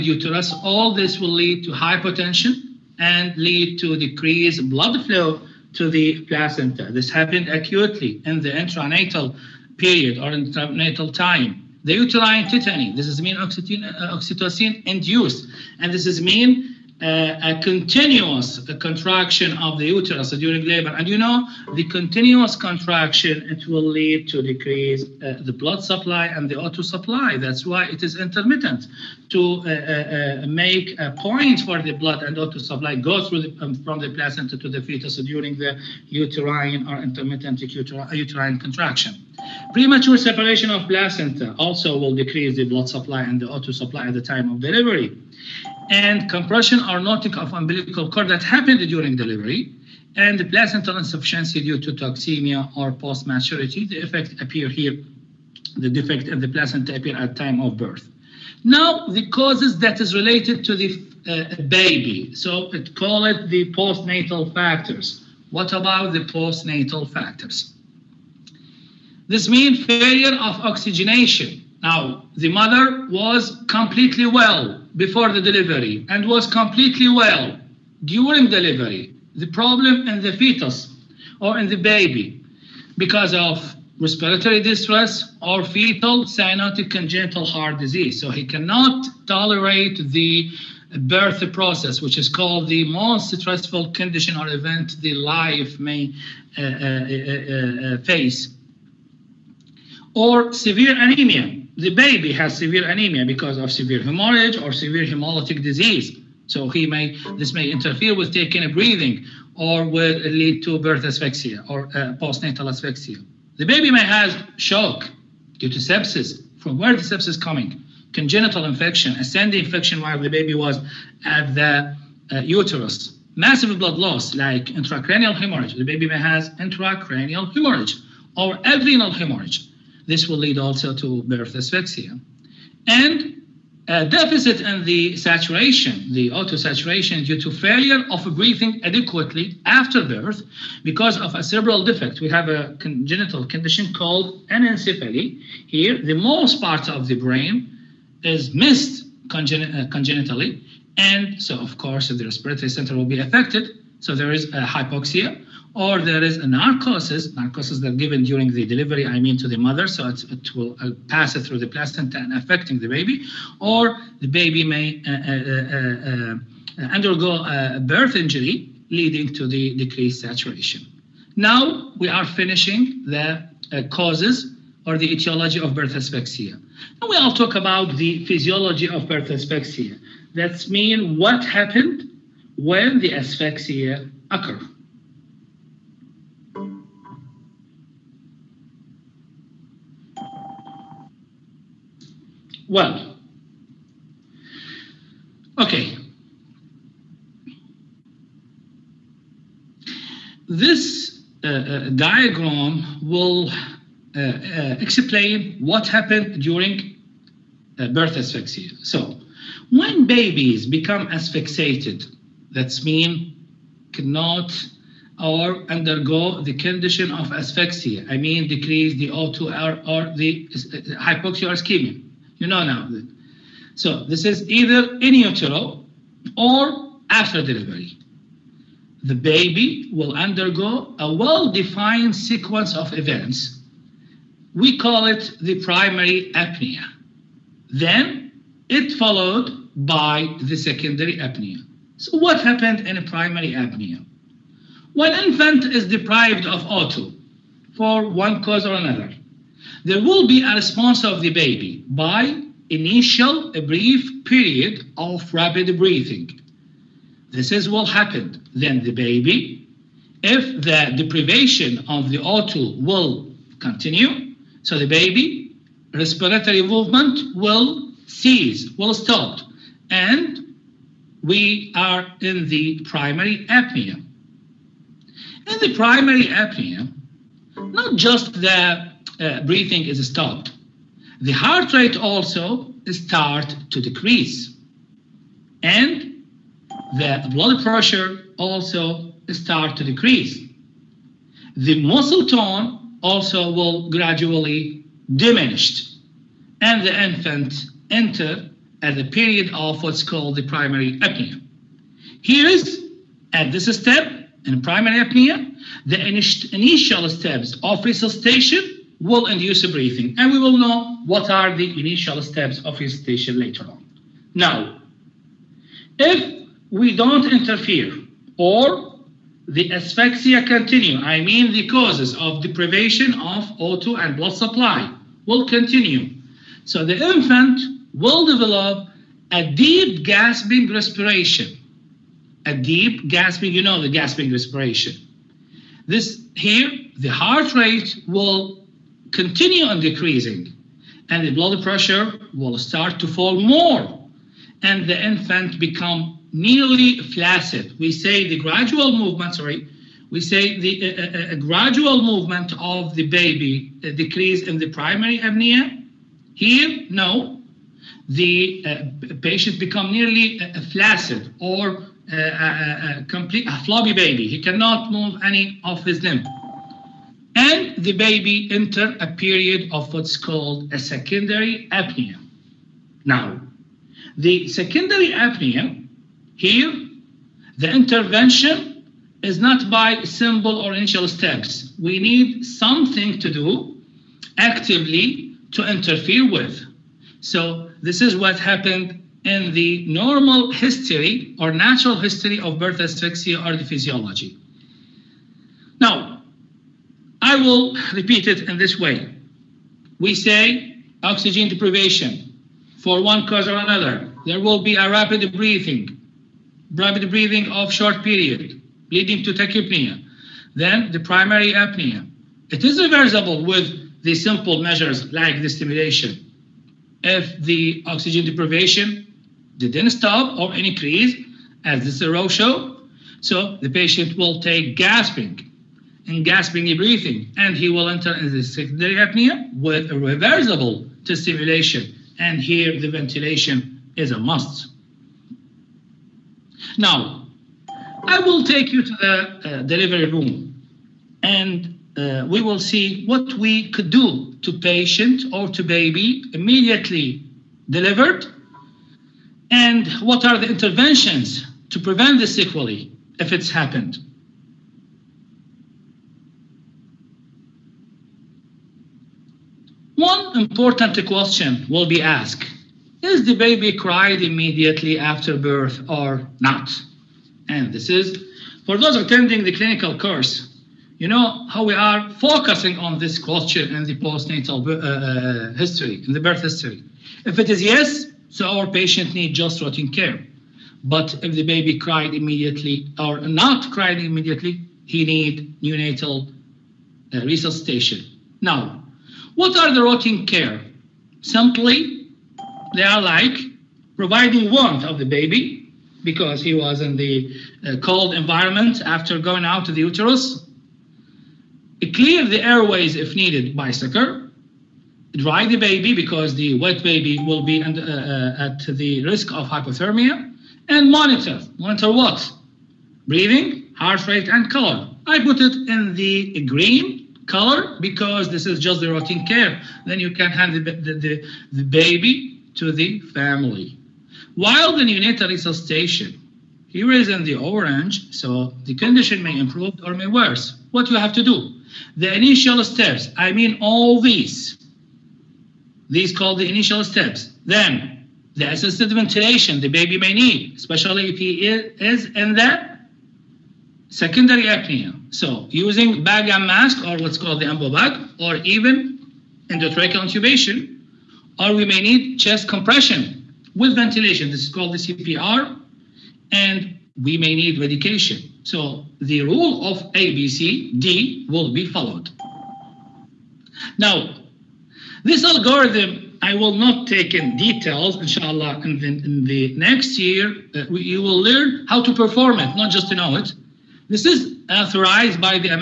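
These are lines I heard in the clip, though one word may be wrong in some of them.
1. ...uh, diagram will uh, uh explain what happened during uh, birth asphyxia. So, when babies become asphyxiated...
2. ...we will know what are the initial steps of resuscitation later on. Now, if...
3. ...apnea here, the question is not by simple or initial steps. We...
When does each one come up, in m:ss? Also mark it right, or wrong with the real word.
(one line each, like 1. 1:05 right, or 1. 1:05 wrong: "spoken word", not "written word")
1. 3:21 right
2. 5:10 right
3. 6:15 wrong: "intervention", not "question".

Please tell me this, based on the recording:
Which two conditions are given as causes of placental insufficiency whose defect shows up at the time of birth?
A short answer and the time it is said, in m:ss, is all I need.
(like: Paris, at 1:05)
Toxemia or post-maturity, at 0:51.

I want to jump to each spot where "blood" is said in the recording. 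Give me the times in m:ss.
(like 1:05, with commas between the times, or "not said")
0:04, 0:25, 0:31, 0:42, 2:03, 4:47, 5:24, 5:41.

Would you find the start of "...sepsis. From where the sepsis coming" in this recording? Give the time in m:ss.
1:55.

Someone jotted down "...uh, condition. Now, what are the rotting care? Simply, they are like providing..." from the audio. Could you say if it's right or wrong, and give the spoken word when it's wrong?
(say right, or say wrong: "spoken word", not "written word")
wrong: "resuscitation", not "condition".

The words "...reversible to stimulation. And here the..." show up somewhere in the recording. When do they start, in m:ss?
7:09.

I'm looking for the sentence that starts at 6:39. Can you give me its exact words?
We say oxygen deprivation for one cause or another.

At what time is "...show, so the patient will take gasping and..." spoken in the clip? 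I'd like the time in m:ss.
7:02.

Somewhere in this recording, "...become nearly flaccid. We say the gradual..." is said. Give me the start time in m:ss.
5:45.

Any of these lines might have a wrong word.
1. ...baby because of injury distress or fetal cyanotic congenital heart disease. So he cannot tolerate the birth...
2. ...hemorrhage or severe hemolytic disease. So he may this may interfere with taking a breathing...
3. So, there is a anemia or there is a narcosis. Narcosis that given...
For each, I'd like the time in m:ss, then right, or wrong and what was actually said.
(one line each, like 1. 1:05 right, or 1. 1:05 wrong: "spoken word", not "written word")
1. 1:21 wrong: "respiratory", not "injury"
2. 1:44 right
3. 2:33 wrong: "hypoxia", not "anemia".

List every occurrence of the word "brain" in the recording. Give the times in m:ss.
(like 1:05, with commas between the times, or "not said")
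2:27.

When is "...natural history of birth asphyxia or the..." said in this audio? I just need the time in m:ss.
6:31.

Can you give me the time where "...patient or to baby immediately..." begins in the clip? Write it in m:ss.
7:24.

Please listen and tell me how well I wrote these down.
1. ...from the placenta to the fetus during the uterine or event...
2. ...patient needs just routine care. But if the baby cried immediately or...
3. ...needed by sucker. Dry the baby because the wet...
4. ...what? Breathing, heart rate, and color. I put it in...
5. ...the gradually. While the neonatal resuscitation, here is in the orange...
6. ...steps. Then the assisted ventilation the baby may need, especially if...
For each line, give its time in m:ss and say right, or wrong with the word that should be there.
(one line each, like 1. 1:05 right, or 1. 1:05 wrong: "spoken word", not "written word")
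1. 0:33 wrong: "intermittent", not "event"
2. 7:58 right
3. 8:23 right
4. 8:31 right
5. 8:42 wrong: "family", not "gradually"
6. 8:56 right.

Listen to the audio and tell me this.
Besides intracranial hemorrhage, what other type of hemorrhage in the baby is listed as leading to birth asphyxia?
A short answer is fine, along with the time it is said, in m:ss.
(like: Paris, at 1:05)
Adrenal hemorrhage, at 2:08.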